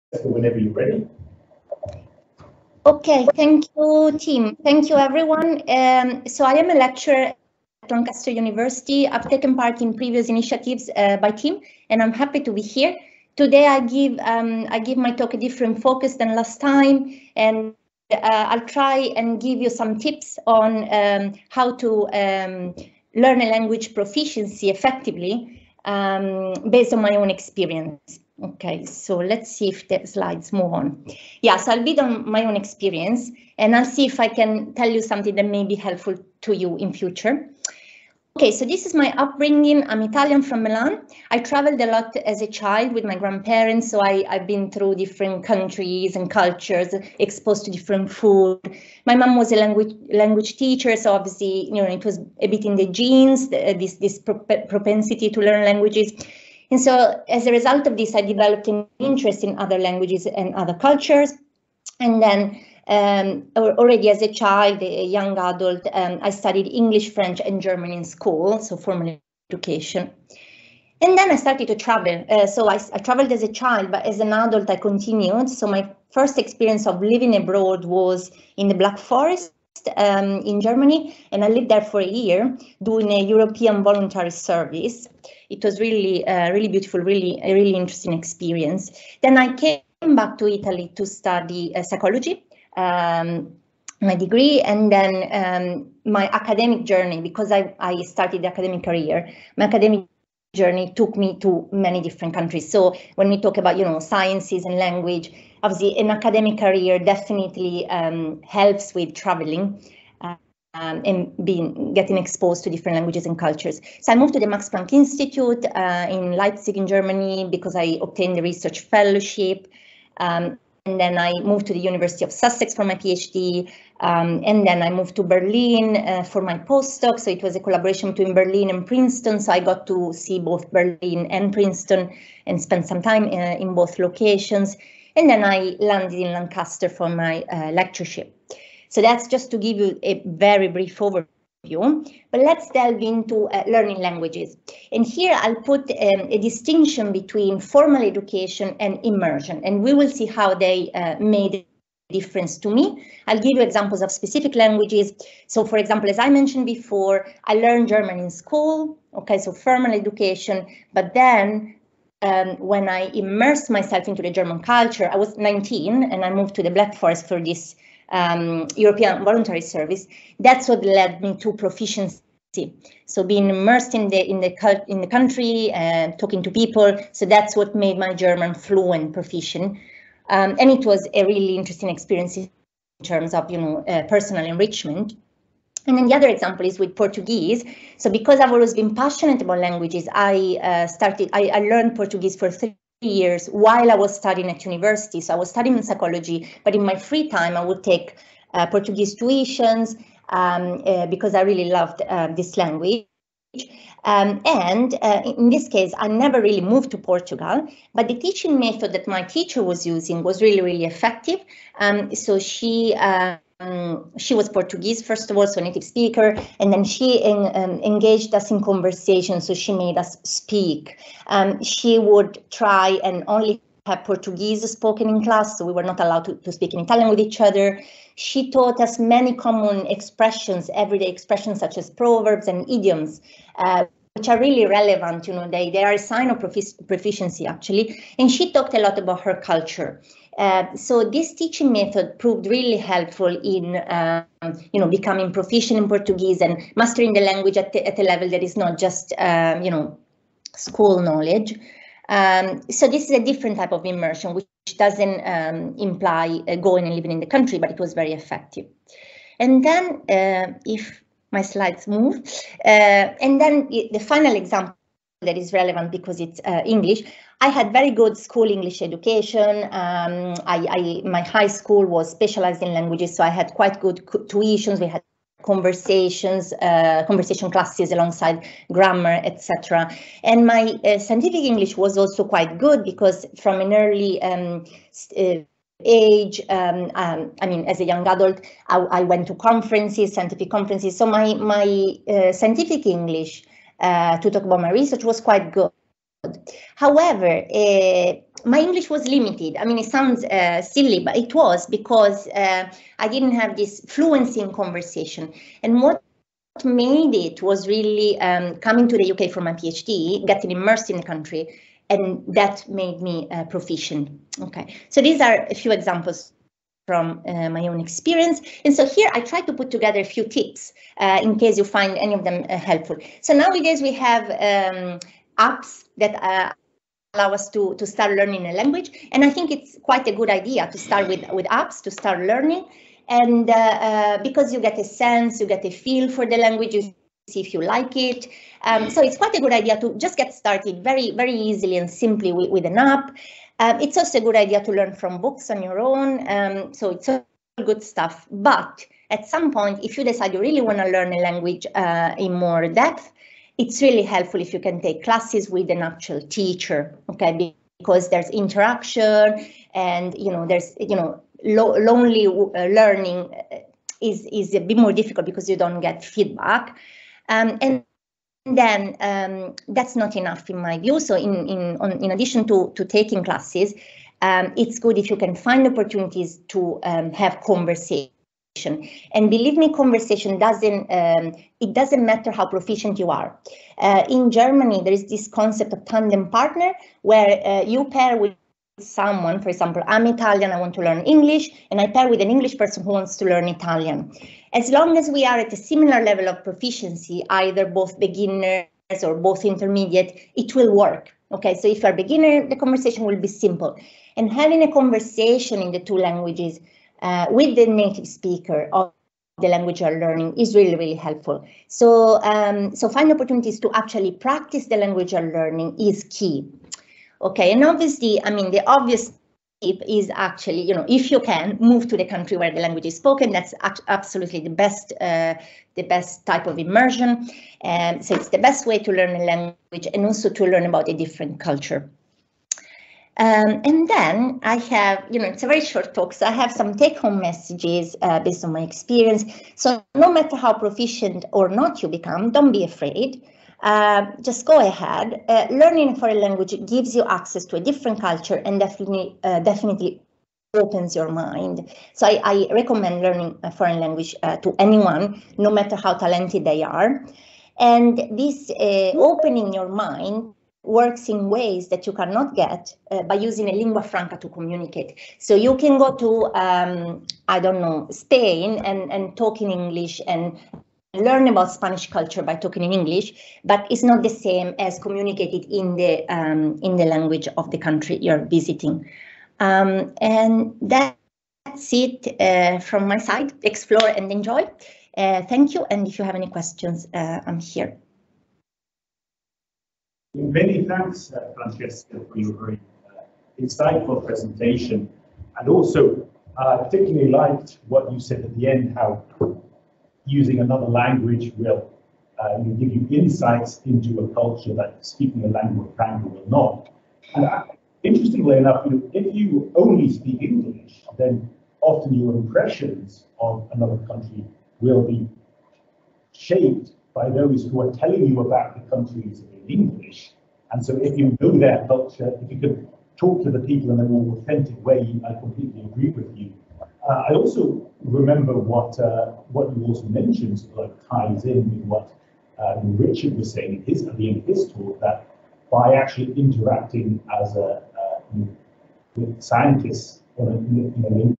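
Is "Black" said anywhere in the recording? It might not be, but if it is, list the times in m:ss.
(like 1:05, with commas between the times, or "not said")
1:18, 2:46.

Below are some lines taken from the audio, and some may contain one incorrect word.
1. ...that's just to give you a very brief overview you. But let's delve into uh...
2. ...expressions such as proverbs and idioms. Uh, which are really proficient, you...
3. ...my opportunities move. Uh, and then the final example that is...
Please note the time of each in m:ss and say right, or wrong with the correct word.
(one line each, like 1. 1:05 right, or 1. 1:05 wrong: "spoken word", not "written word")
1. 2:19 right
2. 3:51 wrong: "relevant", not "proficient"
3. 4:21 wrong: "slides", not "opportunities".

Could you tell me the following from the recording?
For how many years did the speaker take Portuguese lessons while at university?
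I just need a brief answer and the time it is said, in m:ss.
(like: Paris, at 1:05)
3, at 3:12.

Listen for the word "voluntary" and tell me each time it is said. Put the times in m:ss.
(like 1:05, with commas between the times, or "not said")
1:23, 2:49.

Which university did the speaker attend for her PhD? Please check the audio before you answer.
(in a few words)
University of Sussex.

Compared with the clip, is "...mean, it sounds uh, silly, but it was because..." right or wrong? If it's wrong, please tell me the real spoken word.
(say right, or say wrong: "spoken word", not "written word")
right.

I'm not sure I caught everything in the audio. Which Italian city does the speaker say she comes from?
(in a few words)
Milan.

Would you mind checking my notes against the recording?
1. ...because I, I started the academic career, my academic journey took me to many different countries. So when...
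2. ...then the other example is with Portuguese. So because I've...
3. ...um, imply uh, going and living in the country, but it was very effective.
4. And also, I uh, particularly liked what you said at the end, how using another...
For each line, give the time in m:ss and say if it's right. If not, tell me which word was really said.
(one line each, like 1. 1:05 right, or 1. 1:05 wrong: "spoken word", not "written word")
1. 1:37 right
2. 3:05 right
3. 4:15 right
4. 8:15 right.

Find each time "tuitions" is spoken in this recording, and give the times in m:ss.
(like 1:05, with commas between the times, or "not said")
3:19, 4:34.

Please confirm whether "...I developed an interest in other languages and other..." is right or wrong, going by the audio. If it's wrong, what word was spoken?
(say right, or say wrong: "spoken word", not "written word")
right.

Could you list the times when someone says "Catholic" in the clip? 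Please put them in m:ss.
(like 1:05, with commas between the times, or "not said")
not said.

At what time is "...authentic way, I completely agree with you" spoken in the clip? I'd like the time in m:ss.
8:44.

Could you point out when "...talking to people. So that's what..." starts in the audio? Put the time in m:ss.
2:56.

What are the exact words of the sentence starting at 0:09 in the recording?
I've taken part in previous initiatives uh, by Tim, and I'm happy to be here.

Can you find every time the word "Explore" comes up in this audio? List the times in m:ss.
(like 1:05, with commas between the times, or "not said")
8:03.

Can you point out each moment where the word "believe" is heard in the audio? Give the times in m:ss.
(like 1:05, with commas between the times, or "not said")
6:19.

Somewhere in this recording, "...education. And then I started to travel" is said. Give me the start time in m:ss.
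1:09.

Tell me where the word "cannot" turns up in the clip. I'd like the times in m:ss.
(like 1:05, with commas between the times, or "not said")
7:41.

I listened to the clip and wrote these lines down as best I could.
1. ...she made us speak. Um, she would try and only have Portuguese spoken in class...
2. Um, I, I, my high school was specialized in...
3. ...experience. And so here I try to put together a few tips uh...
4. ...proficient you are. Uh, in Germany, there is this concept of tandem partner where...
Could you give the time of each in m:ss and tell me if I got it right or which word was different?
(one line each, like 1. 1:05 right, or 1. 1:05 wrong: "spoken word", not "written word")
1. 3:39 right
2. 4:29 right
3. 5:17 right
4. 6:22 right.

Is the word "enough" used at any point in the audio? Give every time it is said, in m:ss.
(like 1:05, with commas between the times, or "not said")
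6:10, 8:28.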